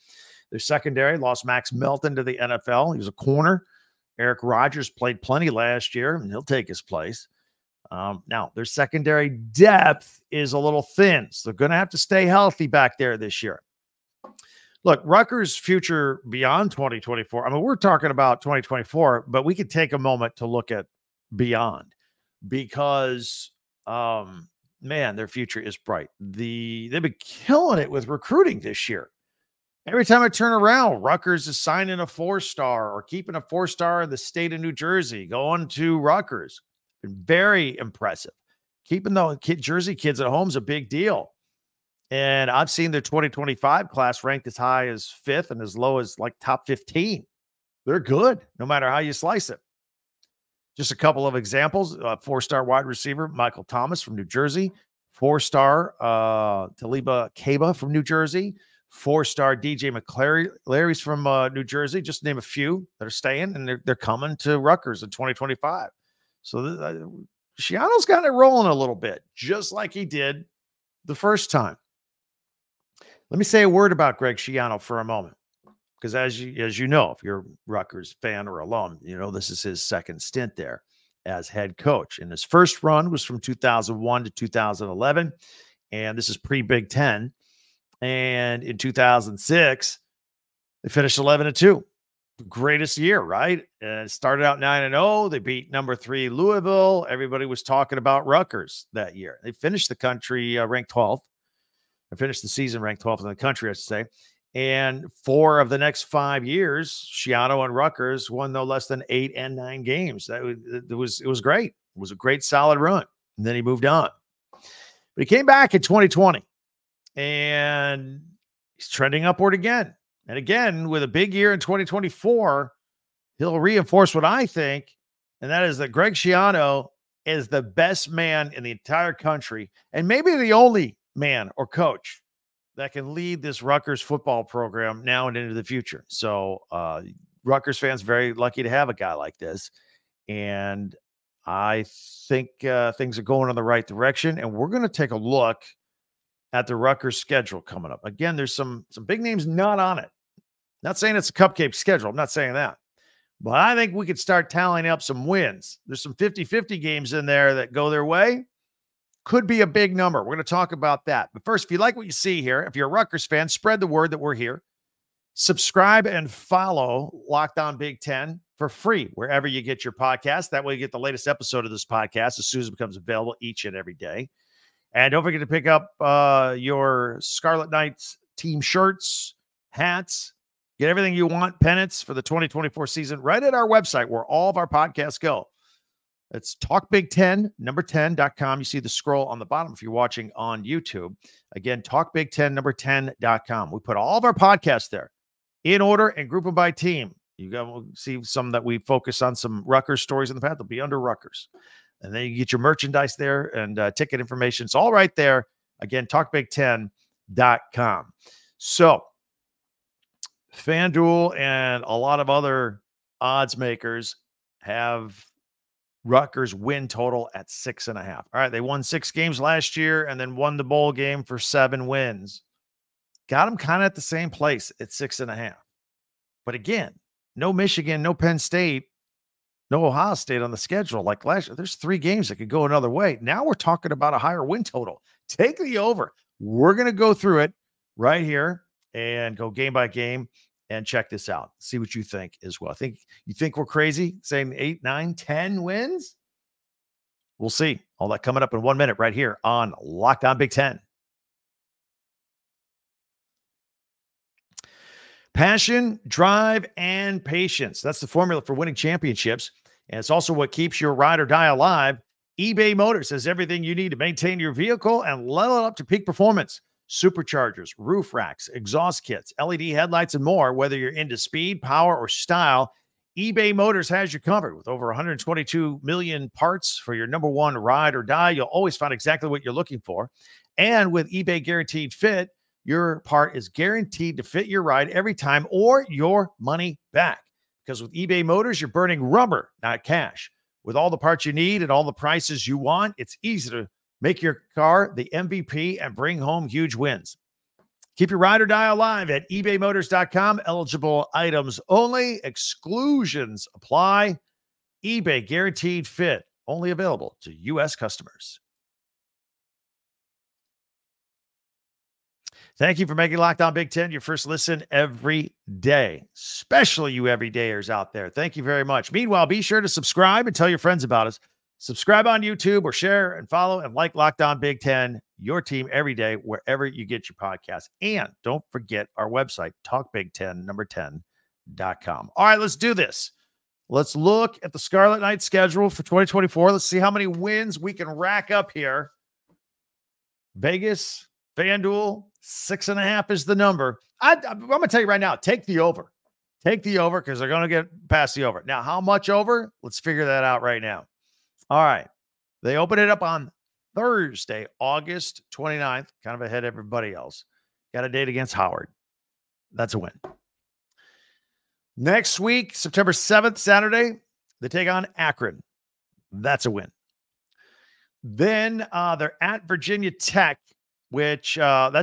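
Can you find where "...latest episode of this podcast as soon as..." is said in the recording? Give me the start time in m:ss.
2:50.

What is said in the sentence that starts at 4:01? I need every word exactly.
See what you think as well.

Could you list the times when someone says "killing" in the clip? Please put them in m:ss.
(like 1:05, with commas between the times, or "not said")
0:27.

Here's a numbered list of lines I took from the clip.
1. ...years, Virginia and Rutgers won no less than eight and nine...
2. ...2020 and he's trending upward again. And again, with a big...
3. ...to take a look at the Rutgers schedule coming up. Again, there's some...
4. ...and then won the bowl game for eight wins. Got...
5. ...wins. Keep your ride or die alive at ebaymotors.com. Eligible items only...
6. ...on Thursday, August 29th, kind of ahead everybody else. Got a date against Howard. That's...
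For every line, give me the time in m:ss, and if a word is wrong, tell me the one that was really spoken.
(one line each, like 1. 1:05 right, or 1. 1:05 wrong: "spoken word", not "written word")
1. 1:46 wrong: "Schiano", not "Virginia"
2. 1:55 right
3. 2:24 right
4. 3:40 wrong: "seven", not "eight"
5. 4:56 right
6. 5:53 right.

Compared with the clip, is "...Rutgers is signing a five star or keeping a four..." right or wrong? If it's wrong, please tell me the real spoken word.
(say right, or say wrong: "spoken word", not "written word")
wrong: "four", not "five".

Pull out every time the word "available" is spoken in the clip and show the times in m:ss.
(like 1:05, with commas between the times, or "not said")
2:52, 5:06.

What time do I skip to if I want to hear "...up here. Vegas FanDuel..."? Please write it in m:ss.
5:38.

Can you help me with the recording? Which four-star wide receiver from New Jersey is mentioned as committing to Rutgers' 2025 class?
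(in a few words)
Michael Thomas.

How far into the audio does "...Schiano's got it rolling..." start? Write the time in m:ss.
1:07.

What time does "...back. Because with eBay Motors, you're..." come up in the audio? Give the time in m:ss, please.
4:46.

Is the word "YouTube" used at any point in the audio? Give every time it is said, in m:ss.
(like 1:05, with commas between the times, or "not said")
3:10, 5:22.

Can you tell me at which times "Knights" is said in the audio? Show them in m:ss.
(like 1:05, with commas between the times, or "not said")
2:57, 5:34.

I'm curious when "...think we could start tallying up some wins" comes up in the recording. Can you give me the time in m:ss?
2:33.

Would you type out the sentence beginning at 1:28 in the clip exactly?
And in 2006, they finished 11 and 2.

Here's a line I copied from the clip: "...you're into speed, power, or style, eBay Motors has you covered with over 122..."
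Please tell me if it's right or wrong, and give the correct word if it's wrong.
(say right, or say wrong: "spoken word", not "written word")
right.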